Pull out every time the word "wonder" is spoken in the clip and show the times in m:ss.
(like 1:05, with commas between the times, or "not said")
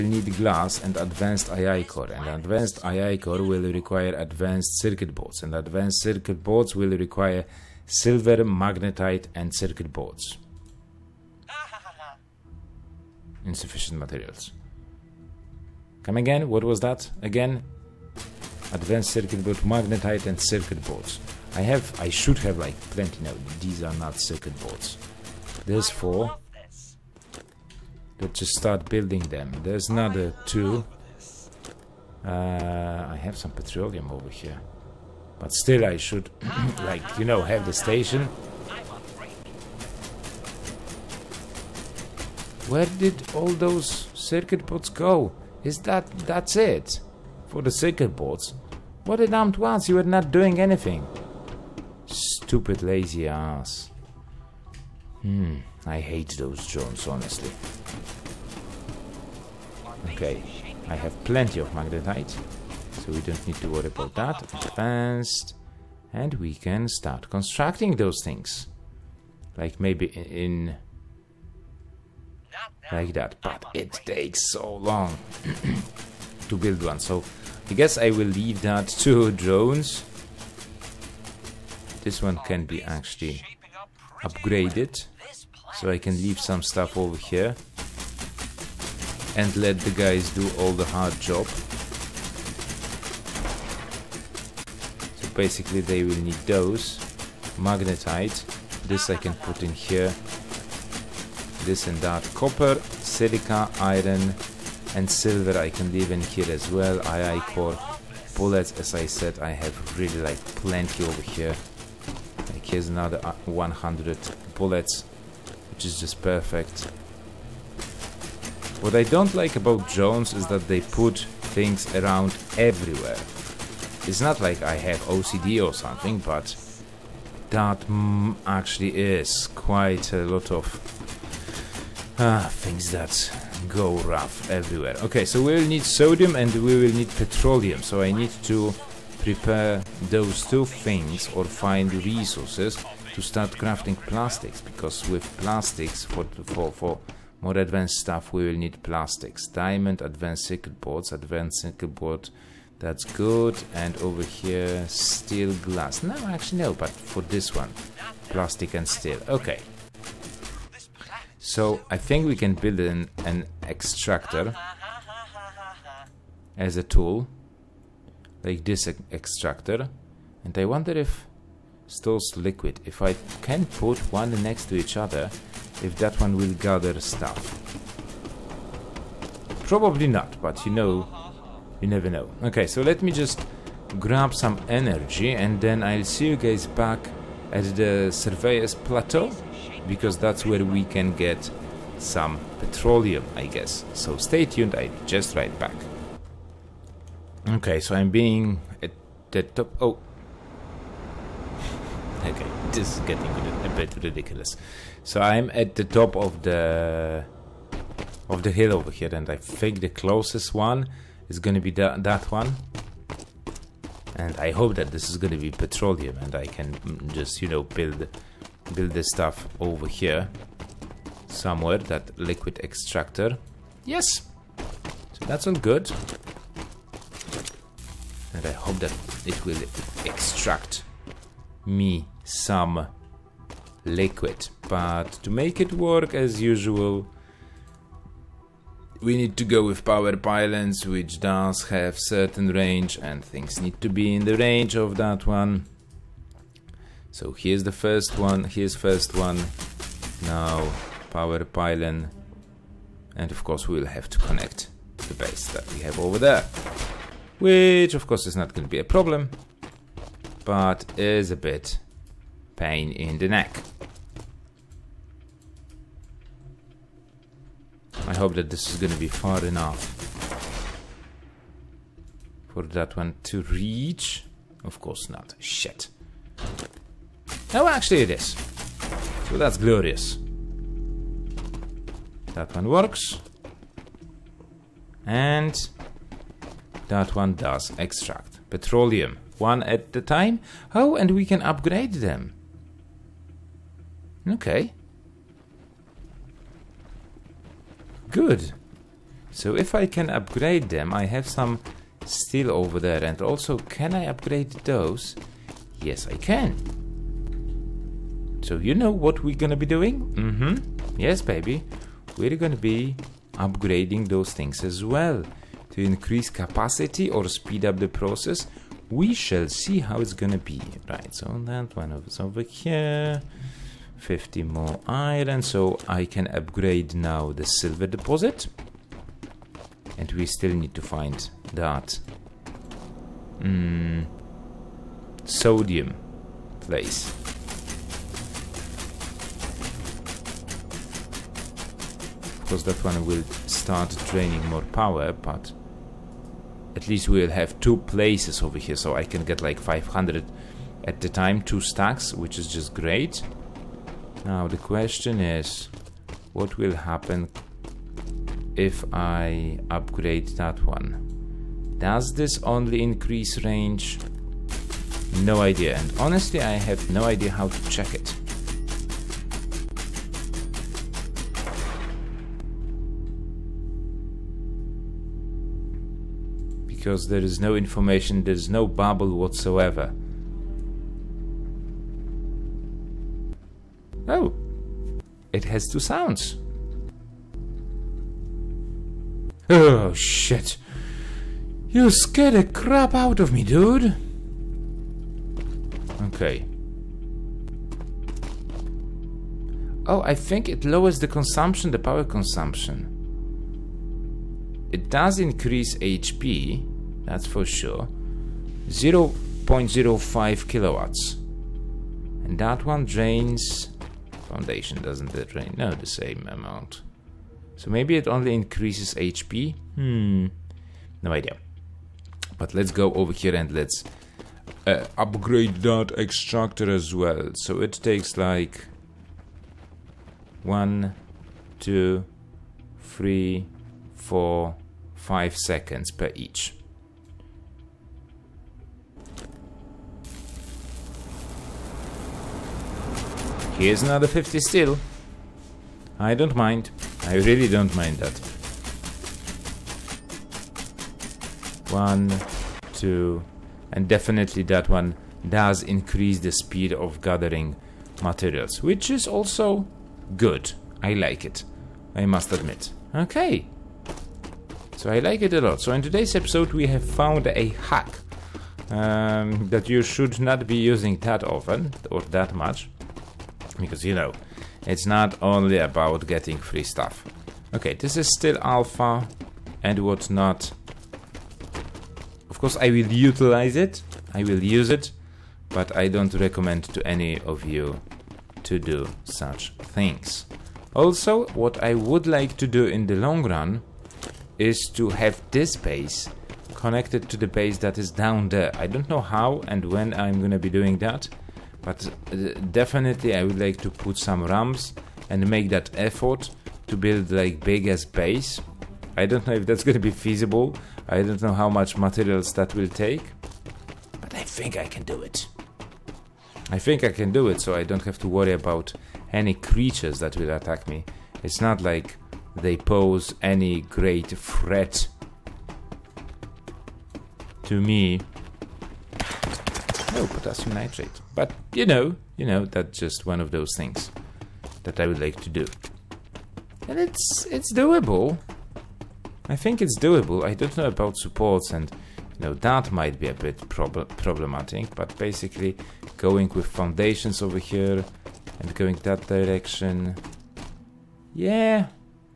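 2:50.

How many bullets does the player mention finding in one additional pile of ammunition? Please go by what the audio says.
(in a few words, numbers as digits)
100.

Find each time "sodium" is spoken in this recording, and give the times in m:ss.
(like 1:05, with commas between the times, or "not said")
2:15, 5:35.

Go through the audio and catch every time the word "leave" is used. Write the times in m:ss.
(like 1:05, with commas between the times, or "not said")
1:18, 1:26, 1:45.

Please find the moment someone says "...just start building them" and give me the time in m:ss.
0:28.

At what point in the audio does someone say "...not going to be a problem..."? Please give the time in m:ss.
4:18.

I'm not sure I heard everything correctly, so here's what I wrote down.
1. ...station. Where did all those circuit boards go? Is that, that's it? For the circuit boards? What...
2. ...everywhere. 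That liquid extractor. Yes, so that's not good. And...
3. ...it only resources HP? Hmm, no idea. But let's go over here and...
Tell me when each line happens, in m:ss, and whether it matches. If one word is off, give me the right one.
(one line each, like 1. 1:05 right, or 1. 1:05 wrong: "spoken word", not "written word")
1. 0:37 right
2. 3:41 wrong: "somewhere", not "everywhere"
3. 6:57 wrong: "increases", not "resources".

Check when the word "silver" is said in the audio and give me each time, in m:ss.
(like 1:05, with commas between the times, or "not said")
0:07, 1:45, 5:27.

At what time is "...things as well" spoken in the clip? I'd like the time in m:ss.
5:14.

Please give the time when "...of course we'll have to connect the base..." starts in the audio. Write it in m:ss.
4:13.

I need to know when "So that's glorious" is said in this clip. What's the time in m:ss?
4:39.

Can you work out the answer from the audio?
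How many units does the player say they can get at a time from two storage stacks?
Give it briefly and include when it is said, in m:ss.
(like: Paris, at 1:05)
500, at 5:49.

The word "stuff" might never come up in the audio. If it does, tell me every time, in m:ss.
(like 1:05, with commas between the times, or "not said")
1:26, 2:27, 2:56, 3:39, 7:56.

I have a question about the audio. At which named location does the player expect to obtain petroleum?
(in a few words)
Surveyor's Plateau.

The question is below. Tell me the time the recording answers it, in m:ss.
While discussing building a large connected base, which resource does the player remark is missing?
8:50.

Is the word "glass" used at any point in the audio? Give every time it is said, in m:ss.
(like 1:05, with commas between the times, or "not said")
0:00, 2:35.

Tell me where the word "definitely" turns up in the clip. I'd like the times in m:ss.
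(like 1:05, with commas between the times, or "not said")
7:33, 8:22.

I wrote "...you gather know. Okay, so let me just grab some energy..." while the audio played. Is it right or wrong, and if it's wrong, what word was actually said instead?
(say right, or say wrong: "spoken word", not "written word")
wrong: "never", not "gather".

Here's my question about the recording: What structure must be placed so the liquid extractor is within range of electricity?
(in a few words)
Power pylons.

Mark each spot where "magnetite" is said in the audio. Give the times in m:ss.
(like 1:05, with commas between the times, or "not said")
0:08, 0:19, 1:01, 1:37.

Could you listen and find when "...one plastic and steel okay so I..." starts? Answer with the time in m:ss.
2:37.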